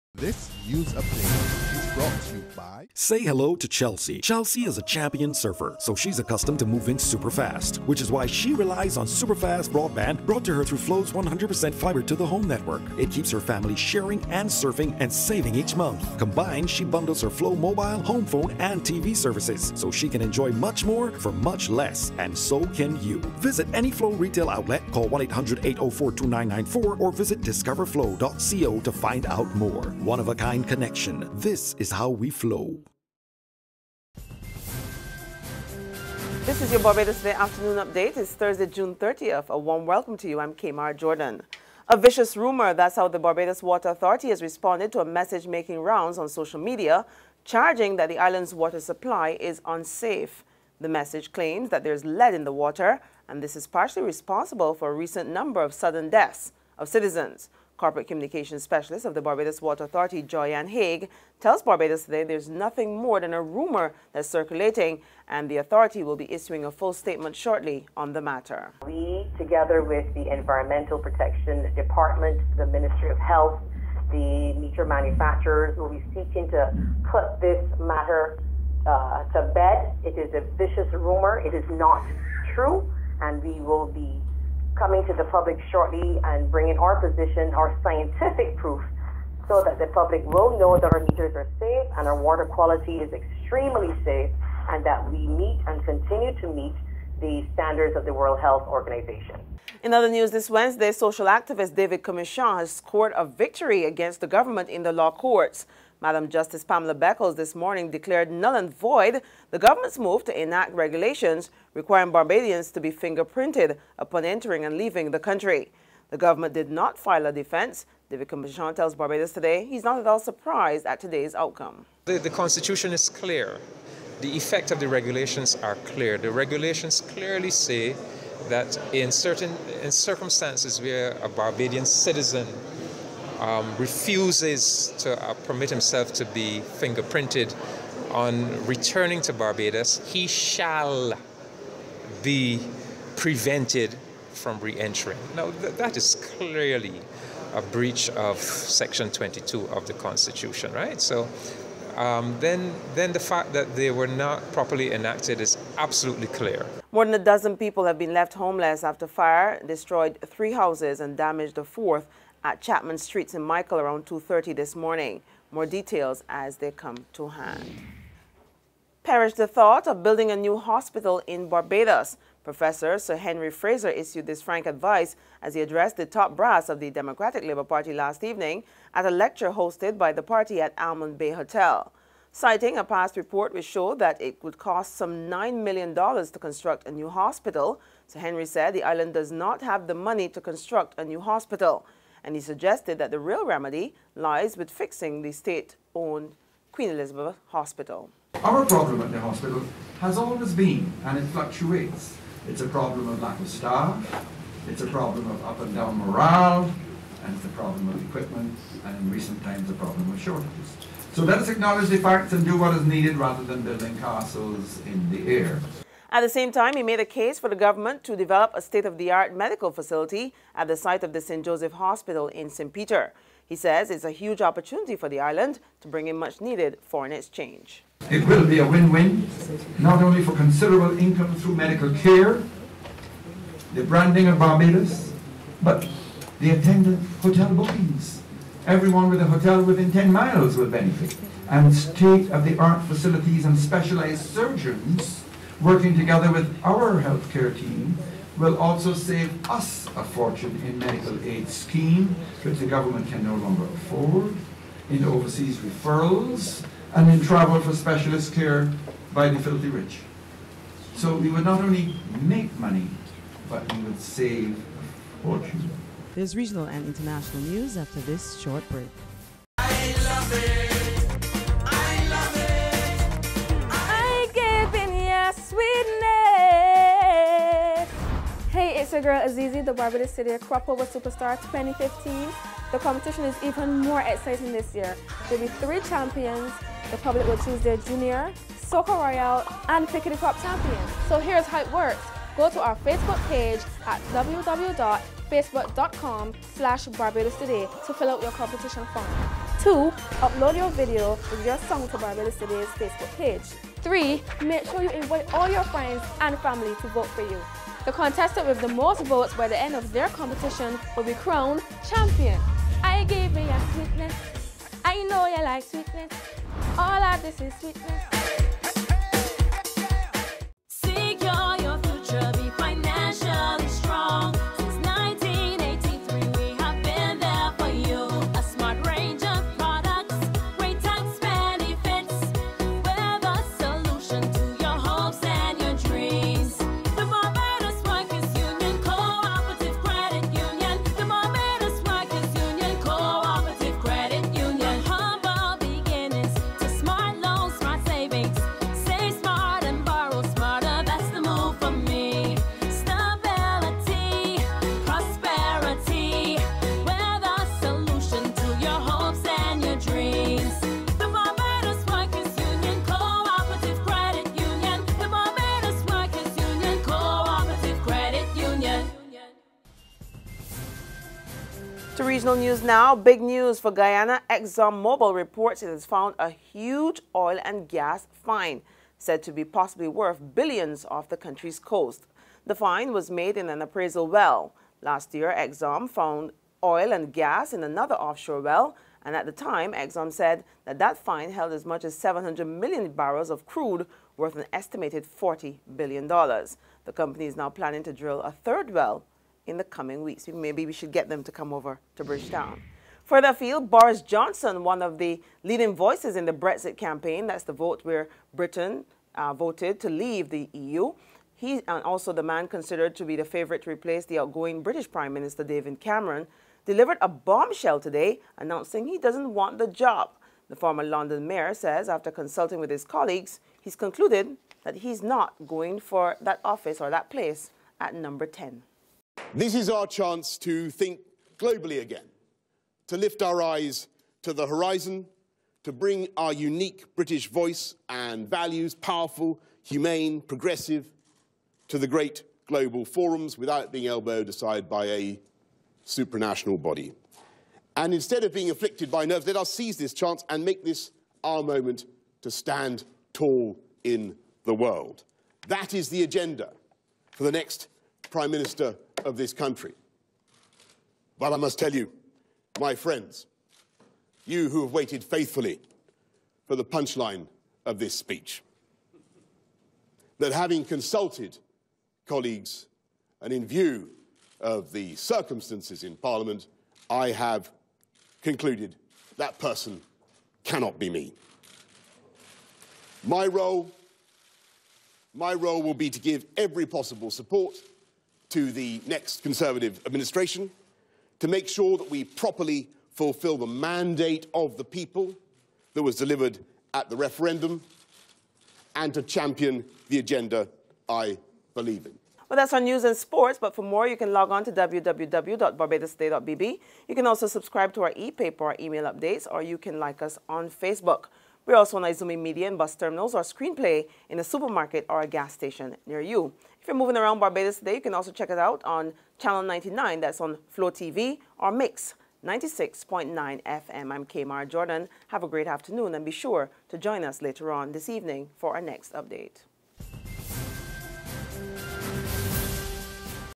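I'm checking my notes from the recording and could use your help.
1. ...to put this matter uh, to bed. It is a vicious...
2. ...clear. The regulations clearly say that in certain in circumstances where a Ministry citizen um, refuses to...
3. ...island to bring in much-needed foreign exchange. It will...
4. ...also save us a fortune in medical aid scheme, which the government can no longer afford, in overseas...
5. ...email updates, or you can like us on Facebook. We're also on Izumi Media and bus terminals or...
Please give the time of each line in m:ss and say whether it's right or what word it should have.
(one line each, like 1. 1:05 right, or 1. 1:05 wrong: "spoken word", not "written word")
1. 1:16 right
2. 2:05 wrong: "Barbadian", not "Ministry"
3. 3:45 right
4. 4:08 right
5. 8:28 right.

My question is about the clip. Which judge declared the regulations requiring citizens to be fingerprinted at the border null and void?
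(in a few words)
Pamela Beckles.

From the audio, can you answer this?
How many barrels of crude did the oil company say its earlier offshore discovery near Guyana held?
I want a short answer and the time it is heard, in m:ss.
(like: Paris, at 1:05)
700 million, at 6:31.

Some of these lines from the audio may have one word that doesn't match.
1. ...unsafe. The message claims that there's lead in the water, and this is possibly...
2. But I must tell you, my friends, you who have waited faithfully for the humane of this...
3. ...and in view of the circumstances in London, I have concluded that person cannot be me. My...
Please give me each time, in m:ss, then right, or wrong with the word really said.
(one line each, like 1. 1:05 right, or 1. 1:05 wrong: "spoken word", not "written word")
1. 0:49 wrong: "partially", not "possibly"
2. 7:41 wrong: "punchline", not "humane"
3. 7:53 wrong: "Parliament", not "London".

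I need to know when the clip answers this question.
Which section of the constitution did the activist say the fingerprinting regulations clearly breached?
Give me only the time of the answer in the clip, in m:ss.
2:28.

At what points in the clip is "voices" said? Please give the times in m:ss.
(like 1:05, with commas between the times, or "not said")
6:45, 7:17.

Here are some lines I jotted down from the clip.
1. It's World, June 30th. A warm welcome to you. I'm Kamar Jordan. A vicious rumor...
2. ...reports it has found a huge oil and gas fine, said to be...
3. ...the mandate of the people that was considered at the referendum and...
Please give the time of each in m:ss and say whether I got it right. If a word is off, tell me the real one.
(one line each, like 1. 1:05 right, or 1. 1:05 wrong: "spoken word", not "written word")
1. 0:38 wrong: "Thursday", not "World"
2. 6:15 right
3. 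8:13 wrong: "delivered", not "considered".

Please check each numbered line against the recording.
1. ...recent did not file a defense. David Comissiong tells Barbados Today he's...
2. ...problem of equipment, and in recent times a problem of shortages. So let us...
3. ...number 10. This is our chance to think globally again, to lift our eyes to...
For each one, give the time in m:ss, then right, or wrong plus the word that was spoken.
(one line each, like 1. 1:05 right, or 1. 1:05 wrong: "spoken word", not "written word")
1. 1:56 wrong: "government", not "recent"
2. 3:27 right
3. 7:07 right.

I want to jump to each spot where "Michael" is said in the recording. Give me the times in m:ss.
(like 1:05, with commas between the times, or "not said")
2:43.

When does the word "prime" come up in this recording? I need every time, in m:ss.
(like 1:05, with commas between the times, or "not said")
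6:54, 7:38.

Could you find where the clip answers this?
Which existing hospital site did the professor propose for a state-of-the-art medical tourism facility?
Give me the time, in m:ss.
3:41.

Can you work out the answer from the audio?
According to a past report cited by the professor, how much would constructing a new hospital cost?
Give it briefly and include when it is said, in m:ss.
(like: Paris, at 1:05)
$9 million, at 3:05.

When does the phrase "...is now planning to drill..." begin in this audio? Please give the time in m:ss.
6:37.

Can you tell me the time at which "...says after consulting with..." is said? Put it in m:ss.
7:01.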